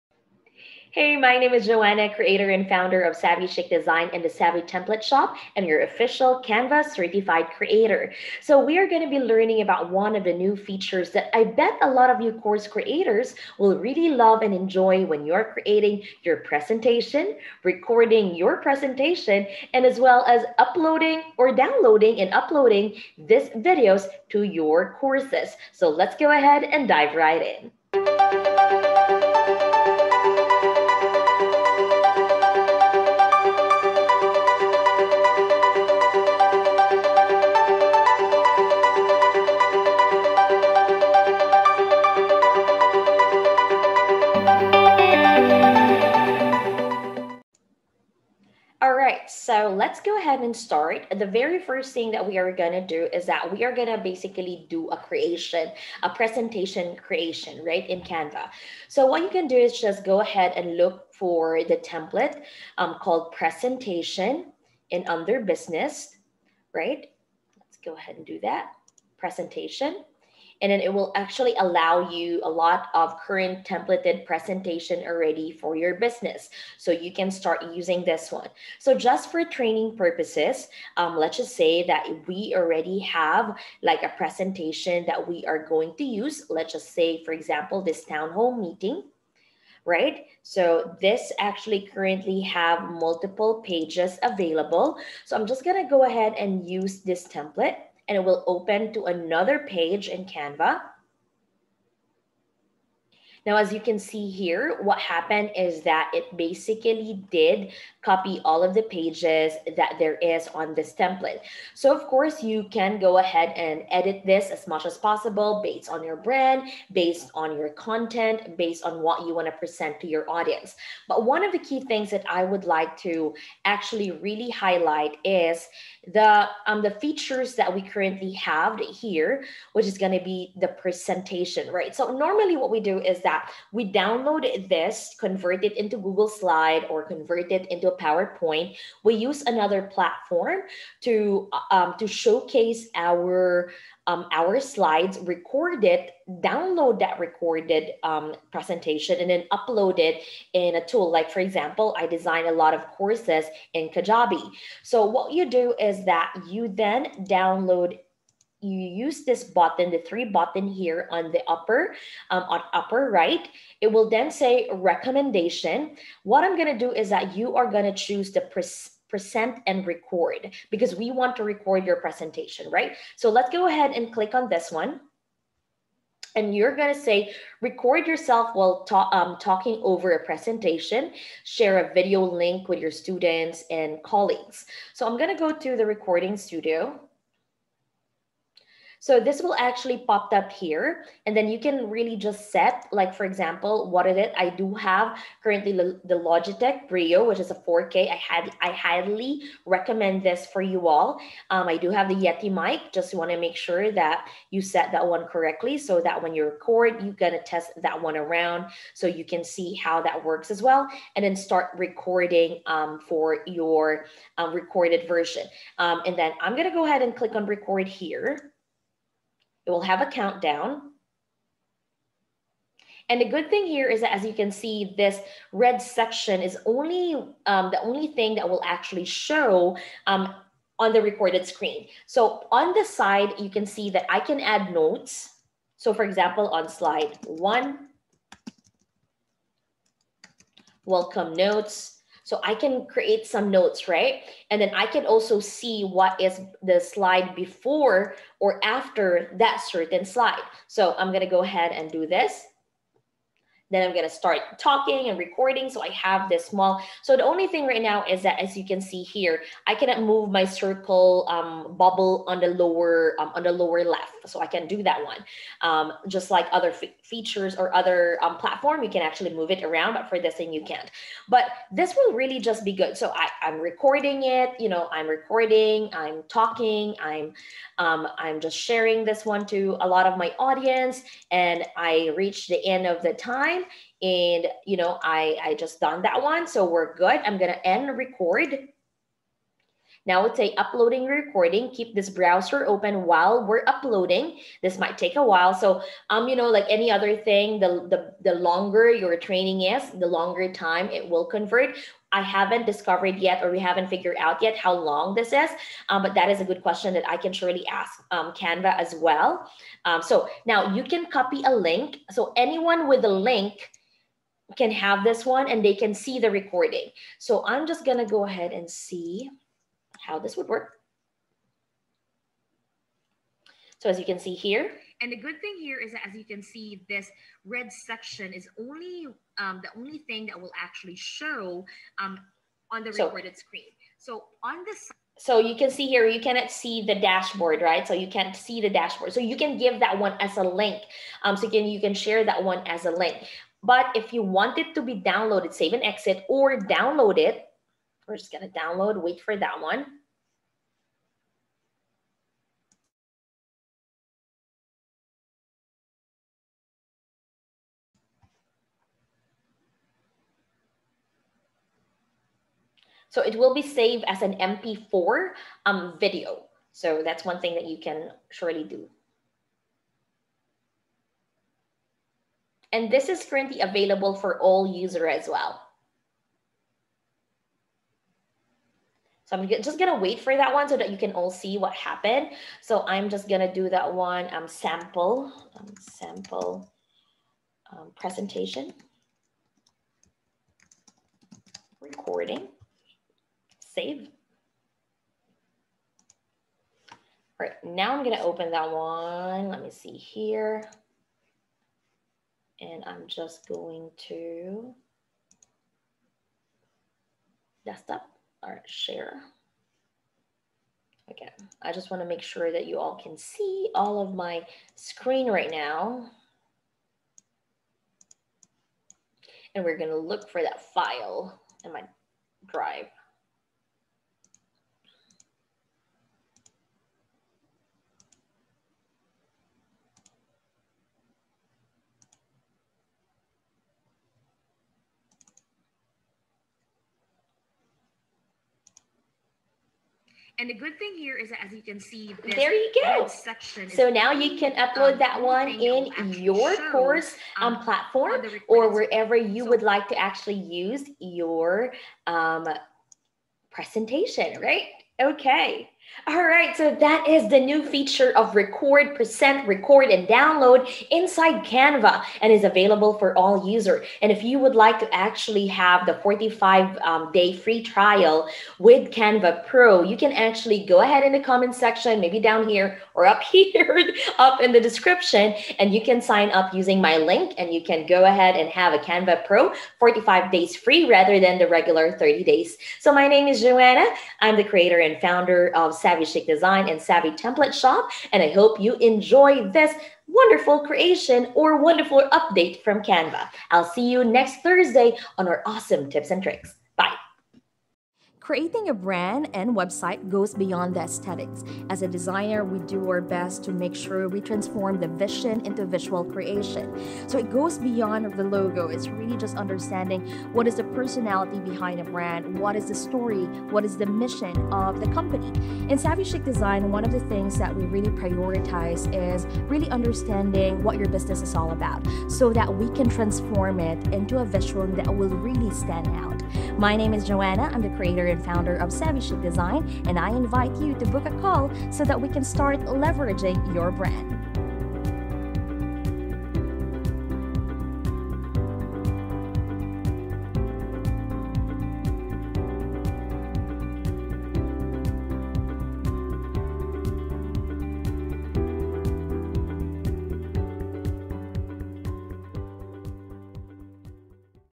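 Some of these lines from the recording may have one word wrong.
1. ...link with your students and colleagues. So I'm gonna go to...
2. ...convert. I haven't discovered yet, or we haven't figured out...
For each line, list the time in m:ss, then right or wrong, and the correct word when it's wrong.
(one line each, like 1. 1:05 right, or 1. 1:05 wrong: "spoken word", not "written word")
1. 3:02 right
2. 5:01 right.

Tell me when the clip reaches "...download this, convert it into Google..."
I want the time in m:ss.
2:13.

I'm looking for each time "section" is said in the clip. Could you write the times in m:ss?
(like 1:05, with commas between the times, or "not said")
3:45, 5:27, 7:23, 7:51.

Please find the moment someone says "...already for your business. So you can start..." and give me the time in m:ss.
1:15.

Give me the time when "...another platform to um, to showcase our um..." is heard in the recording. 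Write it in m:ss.
2:19.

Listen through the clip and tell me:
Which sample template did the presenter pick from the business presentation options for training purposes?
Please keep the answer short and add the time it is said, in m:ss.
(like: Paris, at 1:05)
Town hall meeting, at 1:28.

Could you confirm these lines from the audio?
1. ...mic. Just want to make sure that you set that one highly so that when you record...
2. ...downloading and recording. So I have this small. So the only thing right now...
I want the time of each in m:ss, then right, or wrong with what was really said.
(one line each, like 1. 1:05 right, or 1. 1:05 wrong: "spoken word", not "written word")
1. 3:22 wrong: "correctly", not "highly"
2. 4:14 wrong: "talking", not "downloading".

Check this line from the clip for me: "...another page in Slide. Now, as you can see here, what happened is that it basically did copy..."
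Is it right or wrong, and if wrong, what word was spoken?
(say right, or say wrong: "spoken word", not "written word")
wrong: "Canva", not "Slide".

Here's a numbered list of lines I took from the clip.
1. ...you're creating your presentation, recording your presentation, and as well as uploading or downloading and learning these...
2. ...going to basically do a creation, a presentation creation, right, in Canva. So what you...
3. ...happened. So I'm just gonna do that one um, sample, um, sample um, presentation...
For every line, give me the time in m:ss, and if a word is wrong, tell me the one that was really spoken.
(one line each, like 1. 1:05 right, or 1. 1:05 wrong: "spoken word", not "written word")
1. 0:15 wrong: "uploading", not "learning"
2. 0:53 right
3. 6:21 right.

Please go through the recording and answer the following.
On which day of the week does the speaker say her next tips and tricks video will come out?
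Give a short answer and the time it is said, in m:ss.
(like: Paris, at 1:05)
Thursday, at 8:14.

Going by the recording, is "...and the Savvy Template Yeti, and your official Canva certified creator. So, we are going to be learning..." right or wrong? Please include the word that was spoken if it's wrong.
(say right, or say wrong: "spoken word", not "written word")
wrong: "Shop", not "Yeti".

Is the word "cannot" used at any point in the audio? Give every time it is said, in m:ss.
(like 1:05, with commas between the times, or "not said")
4:19, 5:36.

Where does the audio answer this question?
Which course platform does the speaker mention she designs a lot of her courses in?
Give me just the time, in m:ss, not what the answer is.
2:33.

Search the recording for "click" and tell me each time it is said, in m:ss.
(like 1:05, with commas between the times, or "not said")
2:54, 3:37.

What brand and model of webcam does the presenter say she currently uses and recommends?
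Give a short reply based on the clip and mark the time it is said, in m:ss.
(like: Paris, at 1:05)
Logitech Brio, at 3:16.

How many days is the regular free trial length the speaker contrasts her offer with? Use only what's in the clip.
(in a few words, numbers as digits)
30.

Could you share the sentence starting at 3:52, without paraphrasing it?
So on the side, you can see that I can add notes.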